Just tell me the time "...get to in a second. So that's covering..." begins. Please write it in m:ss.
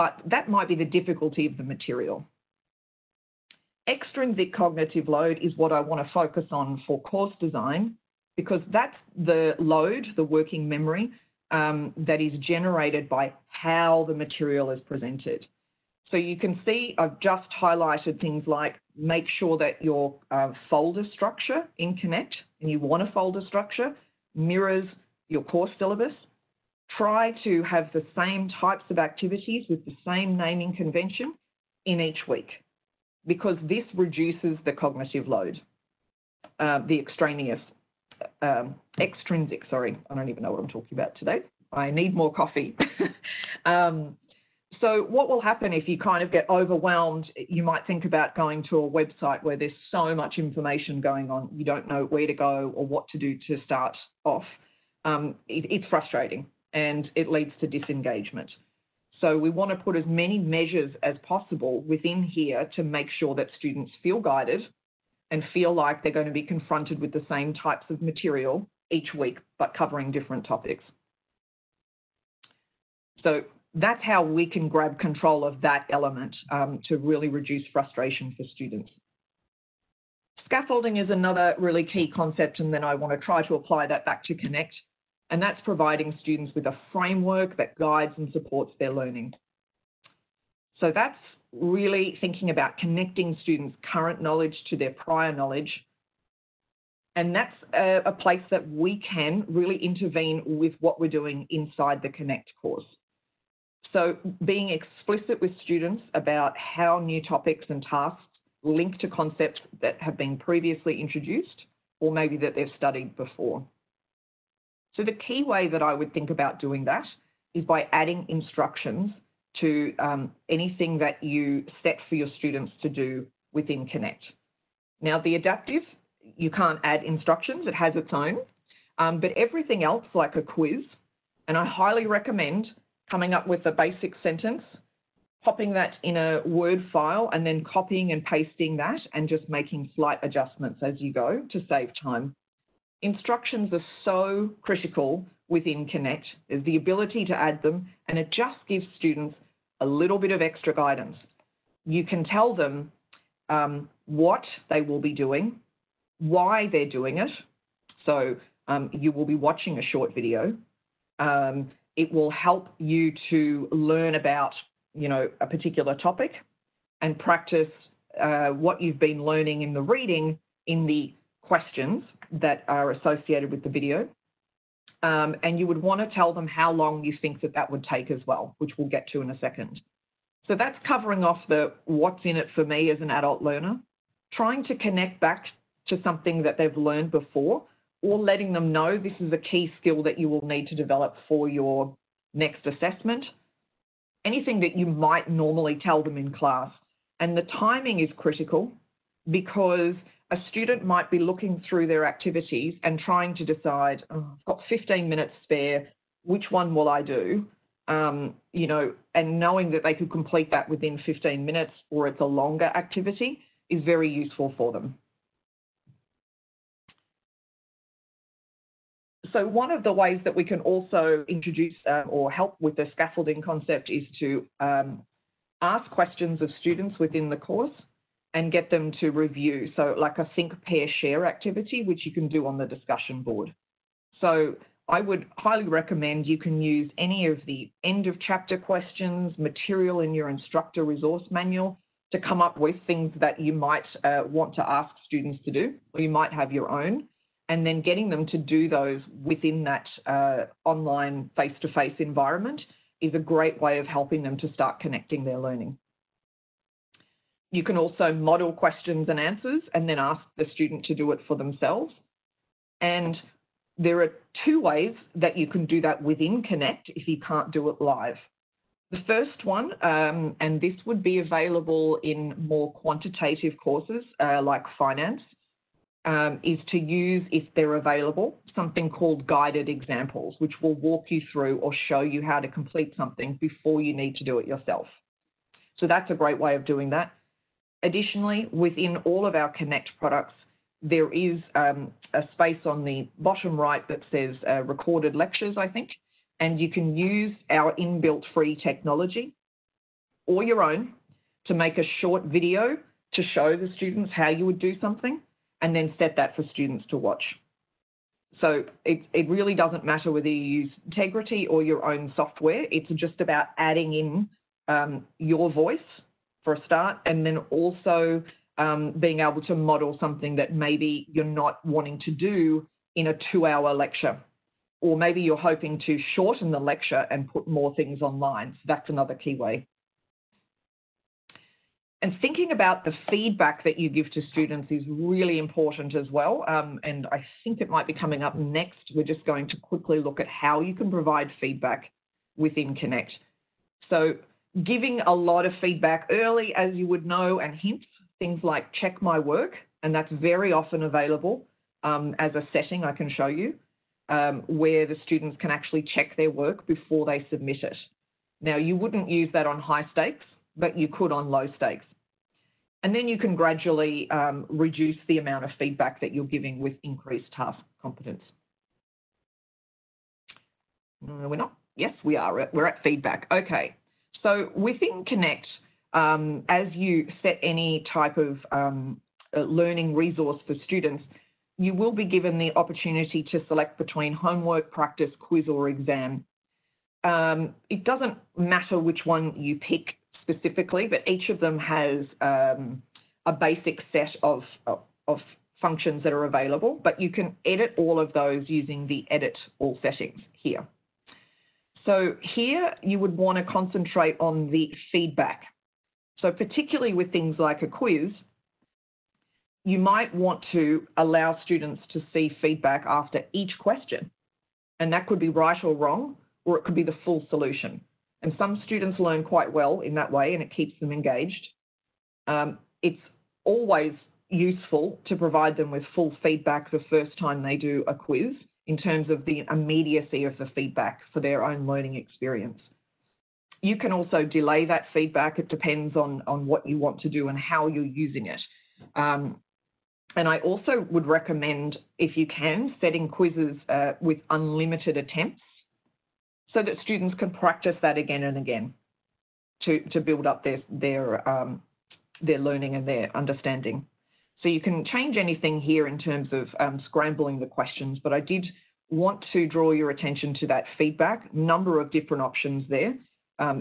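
2:58.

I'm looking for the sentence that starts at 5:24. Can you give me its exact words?
Or maybe you're hoping to shorten the lecture and put more things online.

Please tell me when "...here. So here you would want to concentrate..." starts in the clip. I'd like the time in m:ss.
6:40.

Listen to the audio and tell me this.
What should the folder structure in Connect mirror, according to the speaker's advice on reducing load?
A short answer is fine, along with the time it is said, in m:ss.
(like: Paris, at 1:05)
Course syllabus, at 0:25.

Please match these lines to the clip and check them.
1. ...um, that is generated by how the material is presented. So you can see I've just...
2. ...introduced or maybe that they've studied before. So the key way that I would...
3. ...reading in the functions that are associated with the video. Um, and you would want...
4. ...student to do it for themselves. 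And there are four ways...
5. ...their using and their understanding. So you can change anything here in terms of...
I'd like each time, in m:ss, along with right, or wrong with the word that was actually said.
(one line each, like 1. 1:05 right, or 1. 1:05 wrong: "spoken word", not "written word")
1. 0:11 right
2. 1:50 right
3. 2:49 wrong: "questions", not "functions"
4. 4:20 wrong: "two", not "four"
5. 7:32 wrong: "learning", not "using".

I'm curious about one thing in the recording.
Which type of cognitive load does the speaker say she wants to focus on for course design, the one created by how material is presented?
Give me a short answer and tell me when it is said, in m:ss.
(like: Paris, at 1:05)
Extrinsic cognitive load, at 0:03.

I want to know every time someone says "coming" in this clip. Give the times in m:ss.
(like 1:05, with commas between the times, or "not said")
2:13, 5:37.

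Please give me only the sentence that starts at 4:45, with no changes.
So that's a great way of doing that.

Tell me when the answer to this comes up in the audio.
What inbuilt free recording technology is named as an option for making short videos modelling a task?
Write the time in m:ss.
5:10.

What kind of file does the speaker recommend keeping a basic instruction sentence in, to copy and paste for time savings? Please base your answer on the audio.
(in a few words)
Word file.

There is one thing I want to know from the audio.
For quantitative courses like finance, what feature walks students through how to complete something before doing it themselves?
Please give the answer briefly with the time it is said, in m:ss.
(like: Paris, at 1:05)
Guided examples, at 4:39.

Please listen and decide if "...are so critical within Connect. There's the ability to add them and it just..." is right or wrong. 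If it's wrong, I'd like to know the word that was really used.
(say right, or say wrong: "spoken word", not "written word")
right.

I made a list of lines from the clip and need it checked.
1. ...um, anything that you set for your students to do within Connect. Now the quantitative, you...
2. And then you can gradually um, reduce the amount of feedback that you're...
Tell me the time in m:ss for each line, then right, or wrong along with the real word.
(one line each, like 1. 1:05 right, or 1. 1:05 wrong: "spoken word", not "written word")
1. 1:59 wrong: "adaptive", not "quantitative"
2. 6:02 right.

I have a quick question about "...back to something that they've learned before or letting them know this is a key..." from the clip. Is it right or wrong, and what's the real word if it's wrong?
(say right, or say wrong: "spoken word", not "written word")
right.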